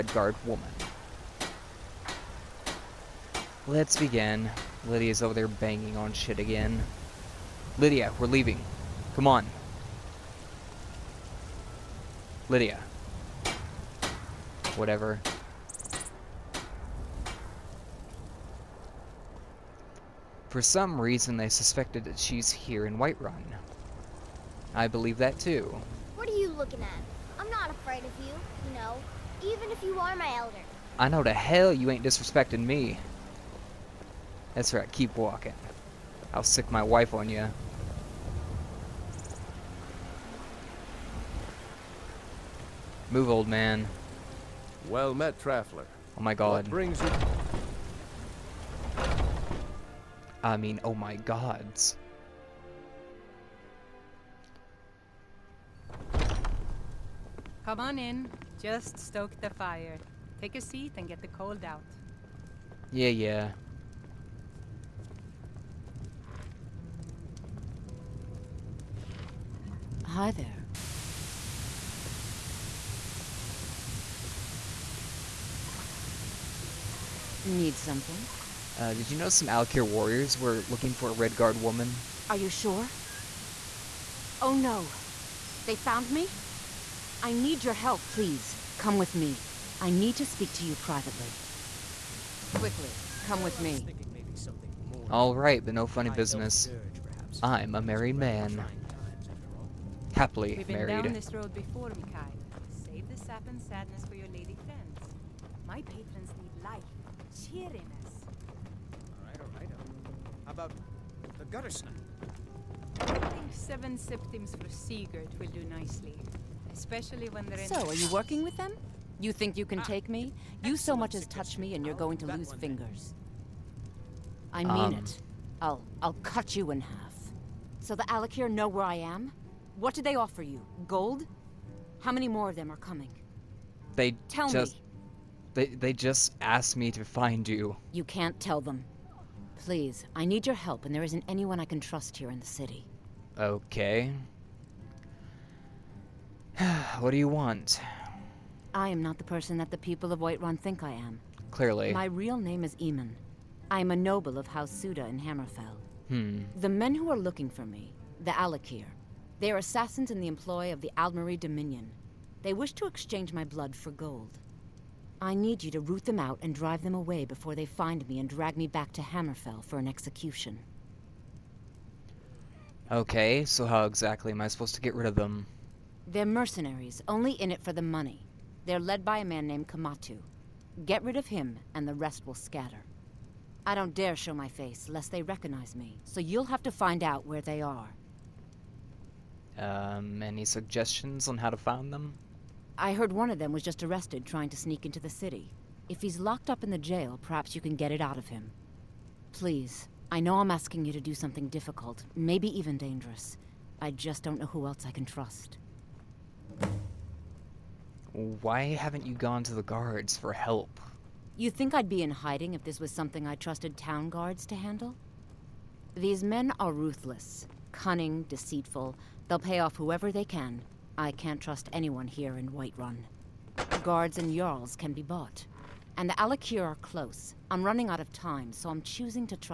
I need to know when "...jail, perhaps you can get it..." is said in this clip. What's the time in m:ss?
3:16.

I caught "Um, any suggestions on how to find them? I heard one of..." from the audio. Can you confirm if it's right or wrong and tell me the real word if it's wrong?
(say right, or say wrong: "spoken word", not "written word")
right.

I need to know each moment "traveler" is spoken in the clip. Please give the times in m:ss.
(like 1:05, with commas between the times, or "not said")
0:45.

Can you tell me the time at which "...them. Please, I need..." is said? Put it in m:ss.
2:18.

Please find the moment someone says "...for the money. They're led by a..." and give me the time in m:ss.
2:57.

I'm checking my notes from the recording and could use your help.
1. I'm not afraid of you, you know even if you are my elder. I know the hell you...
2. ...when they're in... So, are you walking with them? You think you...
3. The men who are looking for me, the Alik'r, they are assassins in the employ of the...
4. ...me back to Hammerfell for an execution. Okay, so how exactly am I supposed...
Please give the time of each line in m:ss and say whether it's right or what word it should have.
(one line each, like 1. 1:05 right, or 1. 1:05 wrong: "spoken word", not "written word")
1. 0:27 right
2. 1:57 wrong: "working", not "walking"
3. 2:36 right
4. 2:48 right.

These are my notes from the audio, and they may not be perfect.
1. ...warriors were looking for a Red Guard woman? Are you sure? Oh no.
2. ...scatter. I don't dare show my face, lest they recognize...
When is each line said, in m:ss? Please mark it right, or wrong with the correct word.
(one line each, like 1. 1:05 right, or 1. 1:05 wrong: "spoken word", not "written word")
1. 1:19 right
2. 3:02 right.